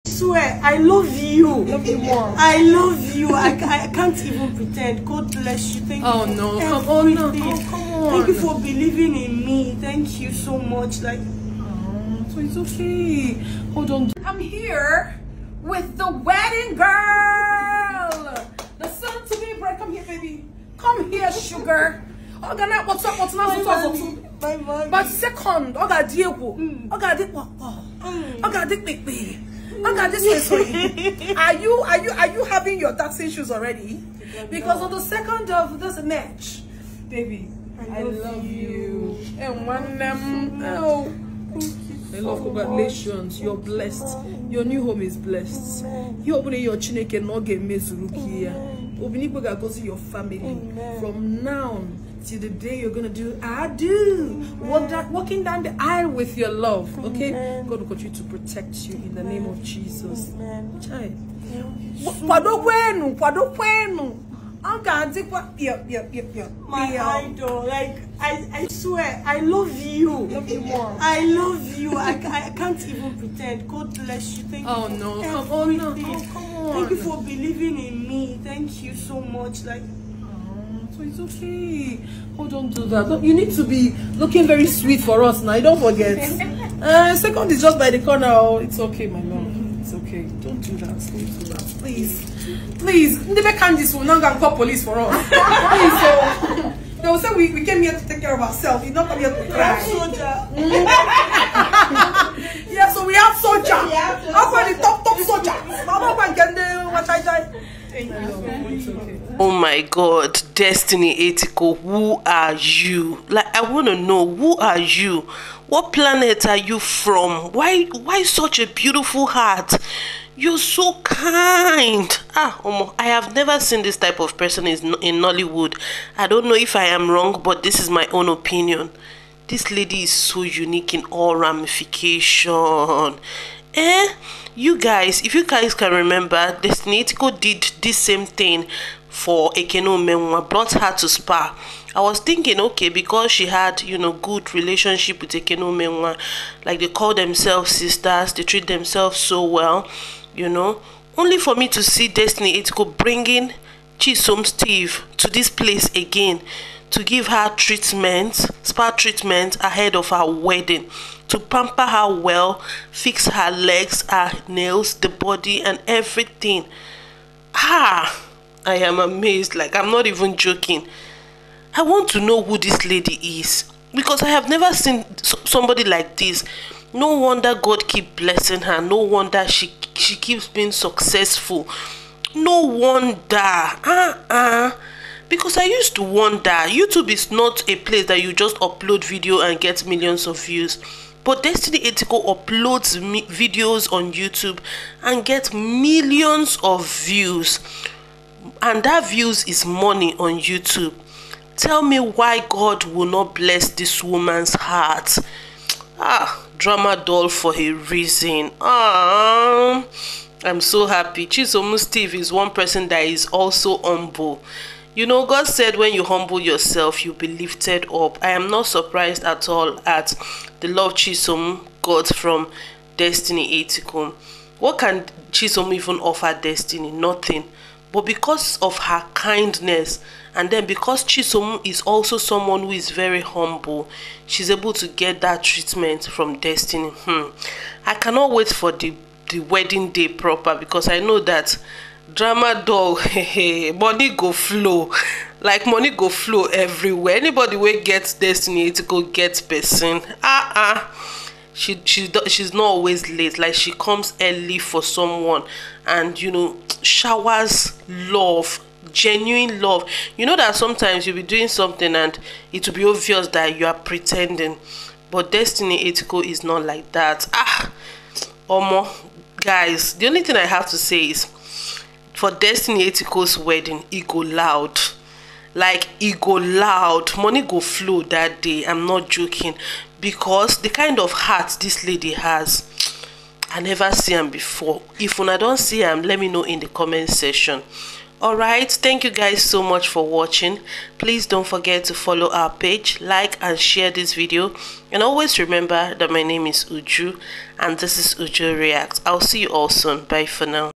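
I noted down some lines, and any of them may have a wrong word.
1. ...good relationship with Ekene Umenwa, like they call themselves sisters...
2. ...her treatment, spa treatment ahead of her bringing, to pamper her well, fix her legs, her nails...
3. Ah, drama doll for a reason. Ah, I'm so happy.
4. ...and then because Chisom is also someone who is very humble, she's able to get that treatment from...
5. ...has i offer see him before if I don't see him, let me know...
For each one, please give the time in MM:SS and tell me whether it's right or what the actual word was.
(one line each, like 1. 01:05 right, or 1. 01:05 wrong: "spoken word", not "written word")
1. 02:24 right
2. 02:37 wrong: "wedding", not "bringing"
3. 03:25 right
4. 03:50 right
5. 04:42 wrong: "never", not "offer".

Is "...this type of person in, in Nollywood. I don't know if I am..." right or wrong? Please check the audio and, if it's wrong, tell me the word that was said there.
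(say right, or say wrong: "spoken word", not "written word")
right.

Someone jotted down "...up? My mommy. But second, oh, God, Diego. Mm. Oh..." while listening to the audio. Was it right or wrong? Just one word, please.
right.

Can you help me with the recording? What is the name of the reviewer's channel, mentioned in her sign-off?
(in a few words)
Uju React.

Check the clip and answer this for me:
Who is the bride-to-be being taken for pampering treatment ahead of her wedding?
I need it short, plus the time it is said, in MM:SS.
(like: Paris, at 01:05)
Chisom Steve, at 02:33.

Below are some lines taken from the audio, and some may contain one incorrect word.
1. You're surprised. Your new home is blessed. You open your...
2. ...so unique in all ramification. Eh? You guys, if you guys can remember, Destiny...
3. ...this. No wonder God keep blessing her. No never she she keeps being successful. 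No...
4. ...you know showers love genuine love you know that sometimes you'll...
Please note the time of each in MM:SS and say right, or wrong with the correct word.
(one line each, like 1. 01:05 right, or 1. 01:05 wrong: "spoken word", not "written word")
1. 00:43 wrong: "blessed", not "surprised"
2. 02:10 right
3. 02:56 wrong: "wonder", not "never"
4. 04:16 right.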